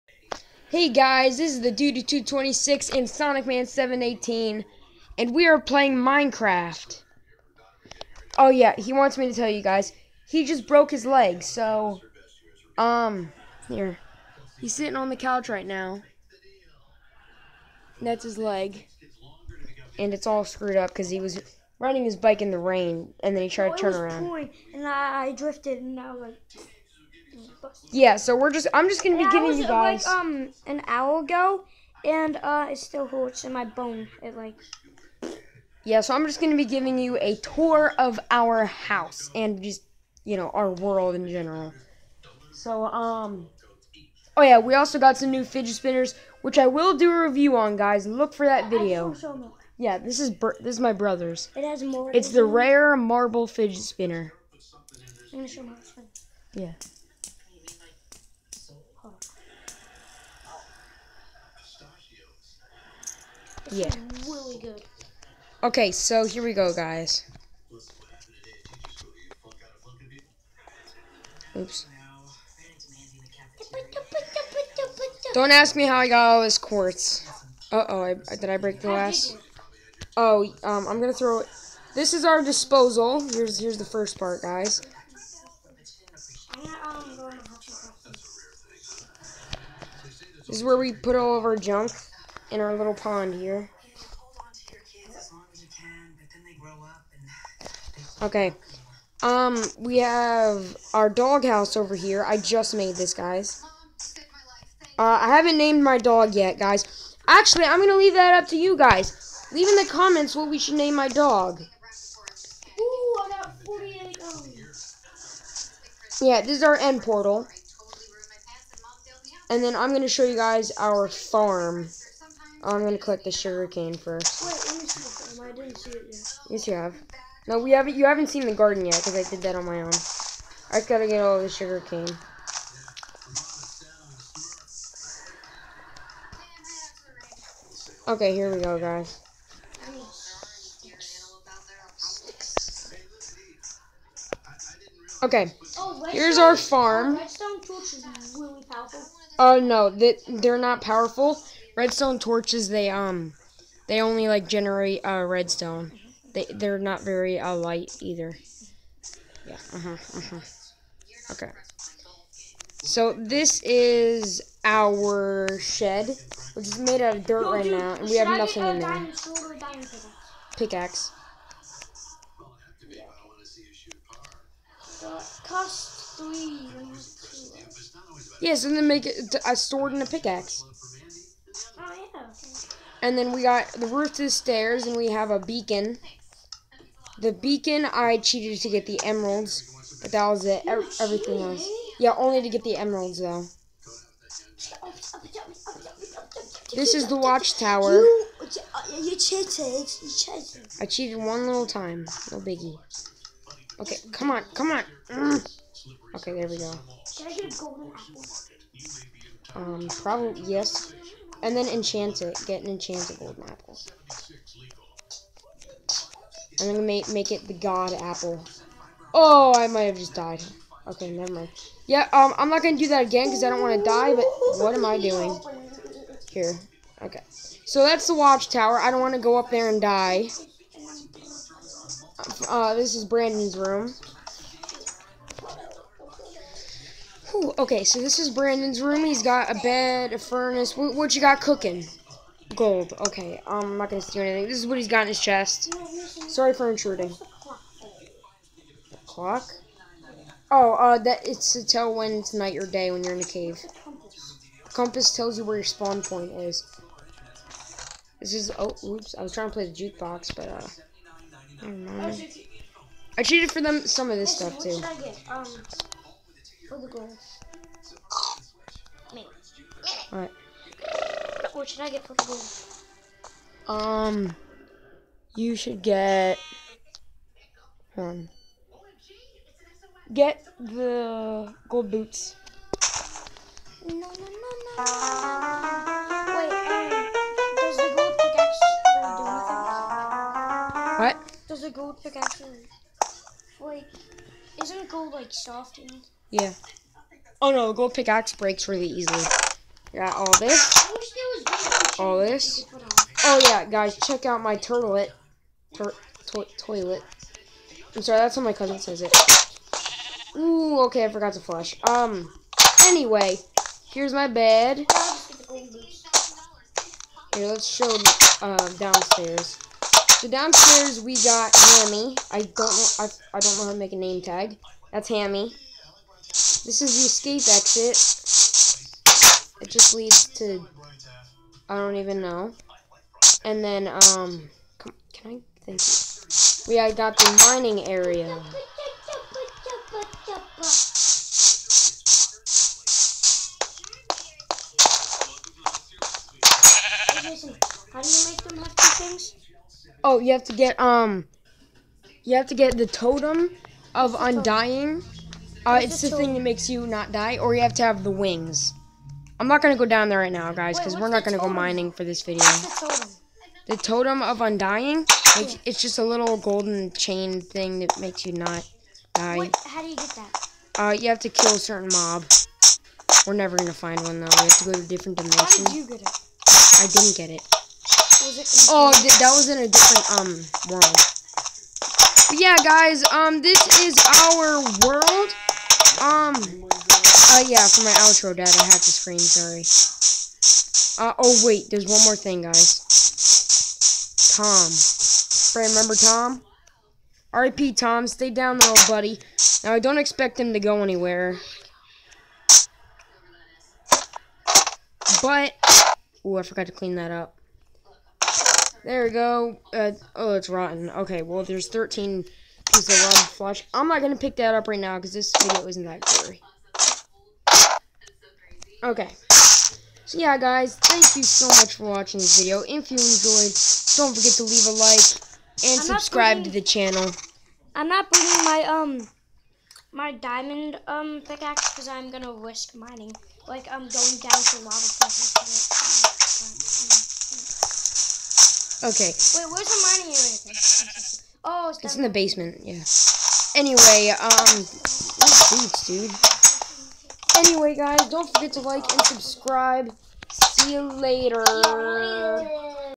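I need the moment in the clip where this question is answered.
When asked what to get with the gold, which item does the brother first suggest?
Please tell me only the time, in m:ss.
4:40.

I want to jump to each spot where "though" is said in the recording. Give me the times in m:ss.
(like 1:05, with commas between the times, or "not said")
3:13, 6:14.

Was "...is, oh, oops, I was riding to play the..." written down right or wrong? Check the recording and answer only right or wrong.
wrong.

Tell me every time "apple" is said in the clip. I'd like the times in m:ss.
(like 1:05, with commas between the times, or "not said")
3:33, 3:38.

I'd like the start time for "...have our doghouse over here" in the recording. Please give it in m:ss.
1:39.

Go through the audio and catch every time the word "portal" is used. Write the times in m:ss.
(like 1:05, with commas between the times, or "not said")
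1:57.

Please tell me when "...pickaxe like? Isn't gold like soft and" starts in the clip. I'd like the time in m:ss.
4:52.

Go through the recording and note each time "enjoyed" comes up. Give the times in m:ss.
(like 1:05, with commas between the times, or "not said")
7:02.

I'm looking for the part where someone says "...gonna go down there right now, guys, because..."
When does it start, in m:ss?
5:59.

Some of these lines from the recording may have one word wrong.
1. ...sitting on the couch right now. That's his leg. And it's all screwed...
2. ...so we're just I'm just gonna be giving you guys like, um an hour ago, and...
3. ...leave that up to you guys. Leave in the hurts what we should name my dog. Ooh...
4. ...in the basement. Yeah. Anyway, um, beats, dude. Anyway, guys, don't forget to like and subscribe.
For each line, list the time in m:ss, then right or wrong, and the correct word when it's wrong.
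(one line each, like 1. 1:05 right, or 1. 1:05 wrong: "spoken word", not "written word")
1. 0:14 right
2. 0:28 right
3. 1:47 wrong: "comments", not "hurts"
4. 7:21 right.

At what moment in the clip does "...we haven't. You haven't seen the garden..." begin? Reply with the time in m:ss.
2:07.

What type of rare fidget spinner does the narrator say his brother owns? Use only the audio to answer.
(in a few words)
Marble.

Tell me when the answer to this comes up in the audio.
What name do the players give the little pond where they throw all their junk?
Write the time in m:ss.
1:21.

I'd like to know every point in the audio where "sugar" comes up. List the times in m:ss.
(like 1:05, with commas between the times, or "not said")
2:03, 2:11.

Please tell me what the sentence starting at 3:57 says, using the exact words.
Whew, okay, so this is Brandon's room.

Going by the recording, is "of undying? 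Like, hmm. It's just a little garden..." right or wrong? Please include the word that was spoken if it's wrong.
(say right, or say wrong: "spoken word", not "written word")
wrong: "golden", not "garden".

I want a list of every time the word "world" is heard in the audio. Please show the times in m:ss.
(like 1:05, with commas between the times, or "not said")
0:40, 6:20, 6:24.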